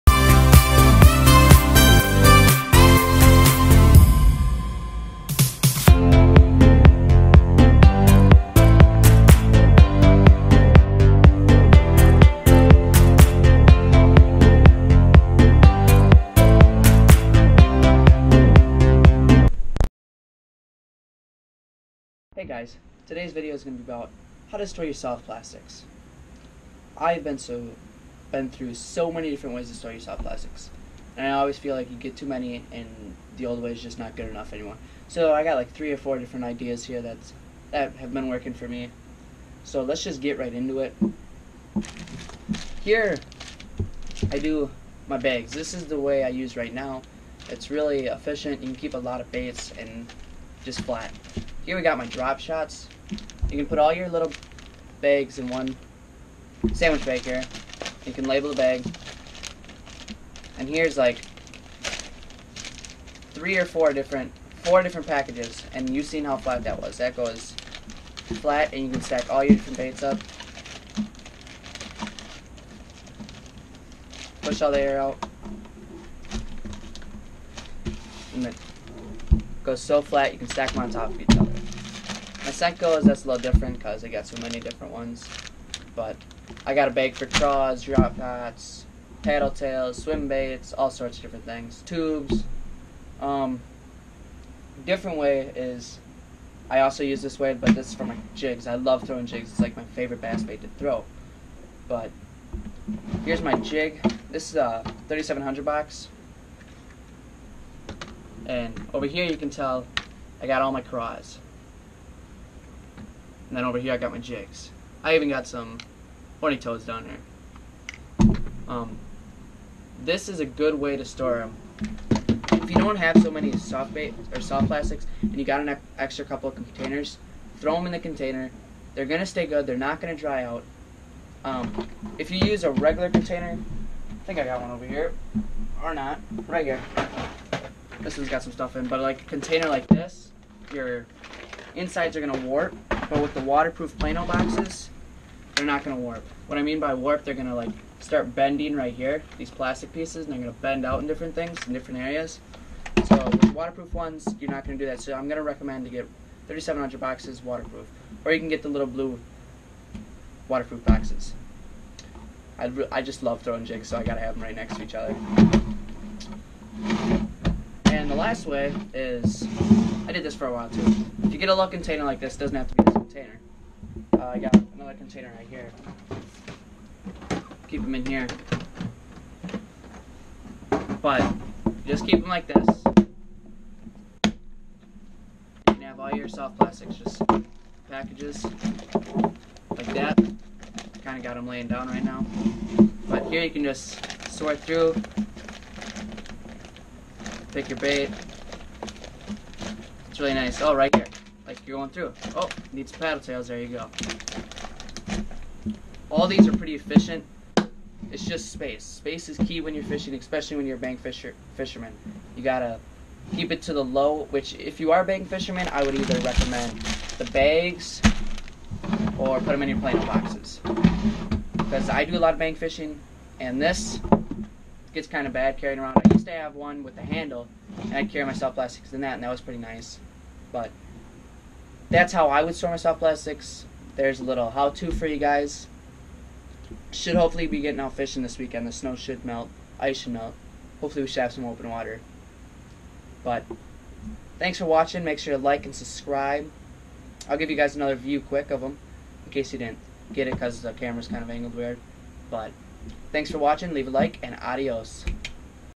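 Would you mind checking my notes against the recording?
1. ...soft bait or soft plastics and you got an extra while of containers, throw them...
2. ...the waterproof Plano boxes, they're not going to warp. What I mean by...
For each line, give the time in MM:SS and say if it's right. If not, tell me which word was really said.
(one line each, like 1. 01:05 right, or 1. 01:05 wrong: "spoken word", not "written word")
1. 02:03 wrong: "couple", not "while"
2. 02:23 right.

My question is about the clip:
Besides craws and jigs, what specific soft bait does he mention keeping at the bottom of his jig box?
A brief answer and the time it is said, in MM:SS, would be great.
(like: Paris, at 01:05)
horny toads, at 01:56.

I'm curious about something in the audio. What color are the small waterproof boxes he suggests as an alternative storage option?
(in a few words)
blue.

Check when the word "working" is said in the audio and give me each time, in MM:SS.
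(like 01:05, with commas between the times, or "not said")
00:38.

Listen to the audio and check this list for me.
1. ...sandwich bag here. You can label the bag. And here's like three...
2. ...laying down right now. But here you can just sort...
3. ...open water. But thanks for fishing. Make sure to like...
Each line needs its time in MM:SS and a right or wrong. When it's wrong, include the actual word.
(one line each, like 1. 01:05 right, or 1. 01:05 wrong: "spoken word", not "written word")
1. 00:56 right
2. 03:11 right
3. 04:01 wrong: "watching", not "fishing".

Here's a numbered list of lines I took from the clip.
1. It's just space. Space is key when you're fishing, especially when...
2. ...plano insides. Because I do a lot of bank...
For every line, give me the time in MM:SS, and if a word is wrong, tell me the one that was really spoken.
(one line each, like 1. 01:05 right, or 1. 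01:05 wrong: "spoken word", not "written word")
1. 03:28 right
2. 03:39 wrong: "boxes", not "insides".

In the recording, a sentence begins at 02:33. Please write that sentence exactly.
So with waterproof ones, you're not going to do that.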